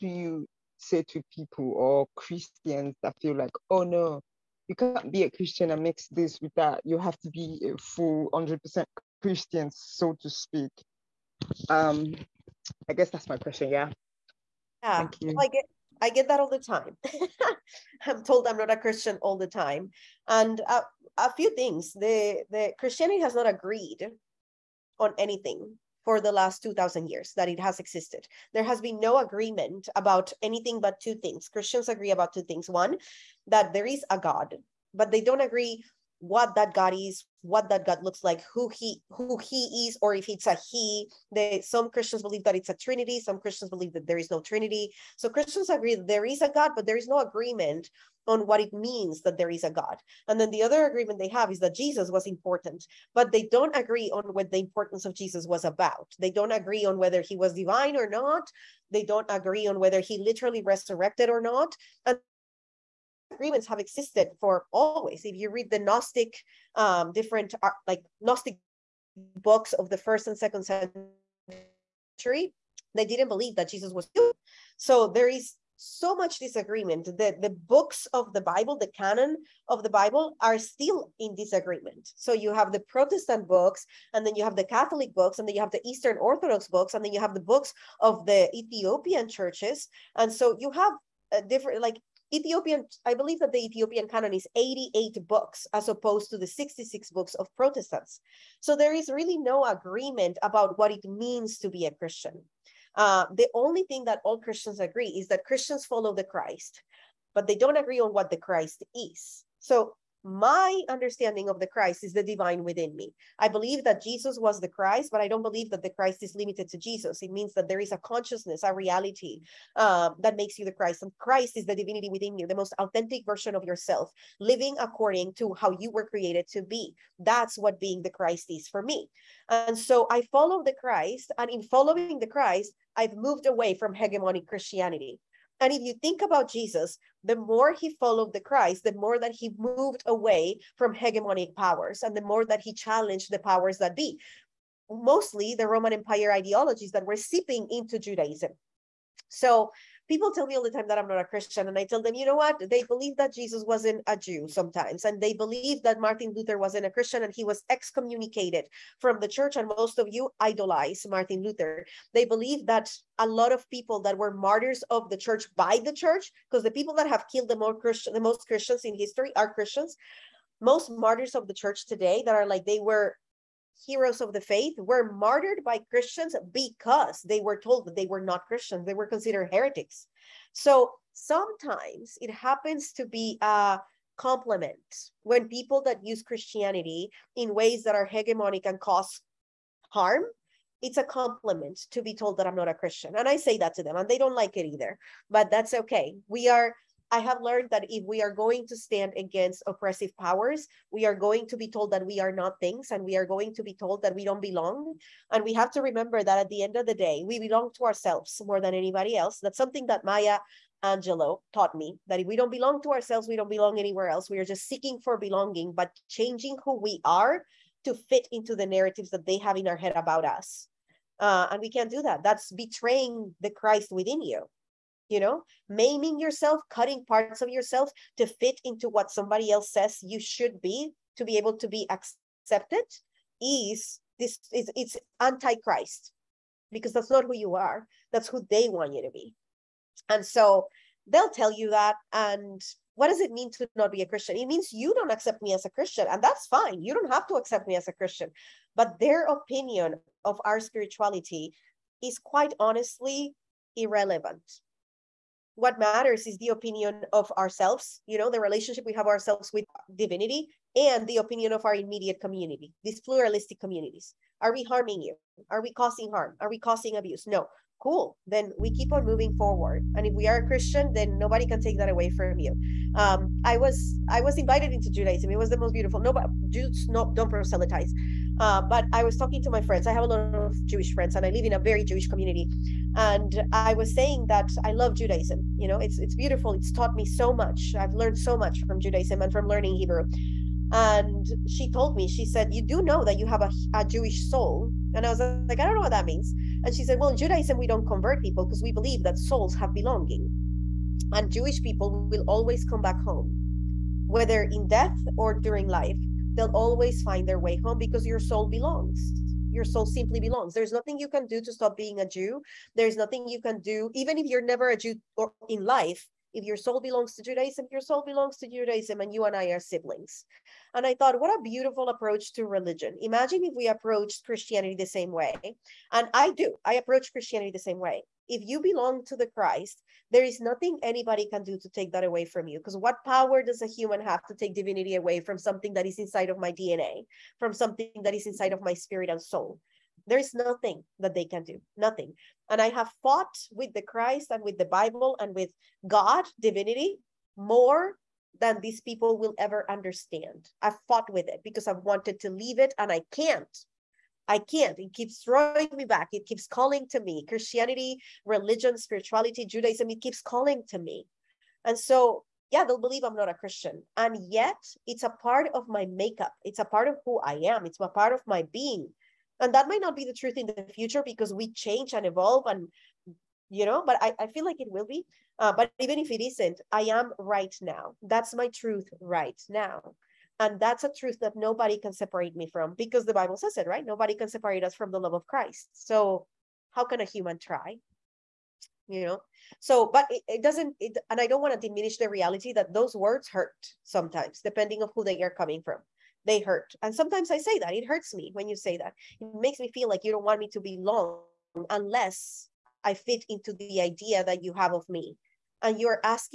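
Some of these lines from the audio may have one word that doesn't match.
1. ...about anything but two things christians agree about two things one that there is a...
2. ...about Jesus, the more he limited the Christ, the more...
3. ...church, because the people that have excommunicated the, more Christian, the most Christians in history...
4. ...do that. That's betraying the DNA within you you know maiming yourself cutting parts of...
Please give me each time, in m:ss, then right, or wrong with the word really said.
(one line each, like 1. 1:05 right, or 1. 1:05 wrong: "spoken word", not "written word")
1. 0:29 right
2. 2:16 wrong: "followed", not "limited"
3. 2:45 wrong: "killed", not "excommunicated"
4. 3:41 wrong: "Christ", not "DNA".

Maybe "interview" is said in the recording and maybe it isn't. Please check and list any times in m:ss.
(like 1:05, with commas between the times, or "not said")
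not said.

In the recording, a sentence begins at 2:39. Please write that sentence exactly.
And most of you idolize Martin Luther.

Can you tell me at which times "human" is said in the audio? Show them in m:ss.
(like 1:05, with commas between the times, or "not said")
1:14, 5:33, 6:27.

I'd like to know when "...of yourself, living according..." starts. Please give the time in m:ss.
2:03.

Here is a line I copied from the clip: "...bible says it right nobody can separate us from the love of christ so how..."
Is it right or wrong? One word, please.
right.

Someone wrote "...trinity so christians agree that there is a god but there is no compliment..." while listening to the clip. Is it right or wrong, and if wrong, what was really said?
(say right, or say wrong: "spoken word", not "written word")
wrong: "agreement", not "compliment".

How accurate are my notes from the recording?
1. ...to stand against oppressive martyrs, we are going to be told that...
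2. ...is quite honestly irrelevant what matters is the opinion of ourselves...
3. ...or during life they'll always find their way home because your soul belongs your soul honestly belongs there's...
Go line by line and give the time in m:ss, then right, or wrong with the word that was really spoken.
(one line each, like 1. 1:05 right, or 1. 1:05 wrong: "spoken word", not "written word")
1. 3:18 wrong: "powers", not "martyrs"
2. 4:12 right
3. 5:05 wrong: "simply", not "honestly".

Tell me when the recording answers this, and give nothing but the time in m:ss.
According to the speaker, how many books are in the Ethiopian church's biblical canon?
1:34.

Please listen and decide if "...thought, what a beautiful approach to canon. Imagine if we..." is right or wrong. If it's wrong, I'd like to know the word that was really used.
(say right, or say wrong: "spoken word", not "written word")
wrong: "religion", not "canon".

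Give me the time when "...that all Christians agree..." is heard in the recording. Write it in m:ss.
1:44.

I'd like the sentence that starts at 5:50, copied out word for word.
I've fought with it because I've wanted to leave it and I can't.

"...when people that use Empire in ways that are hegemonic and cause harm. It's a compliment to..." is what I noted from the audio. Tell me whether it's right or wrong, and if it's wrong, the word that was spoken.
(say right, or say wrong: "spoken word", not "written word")
wrong: "Christianity", not "Empire".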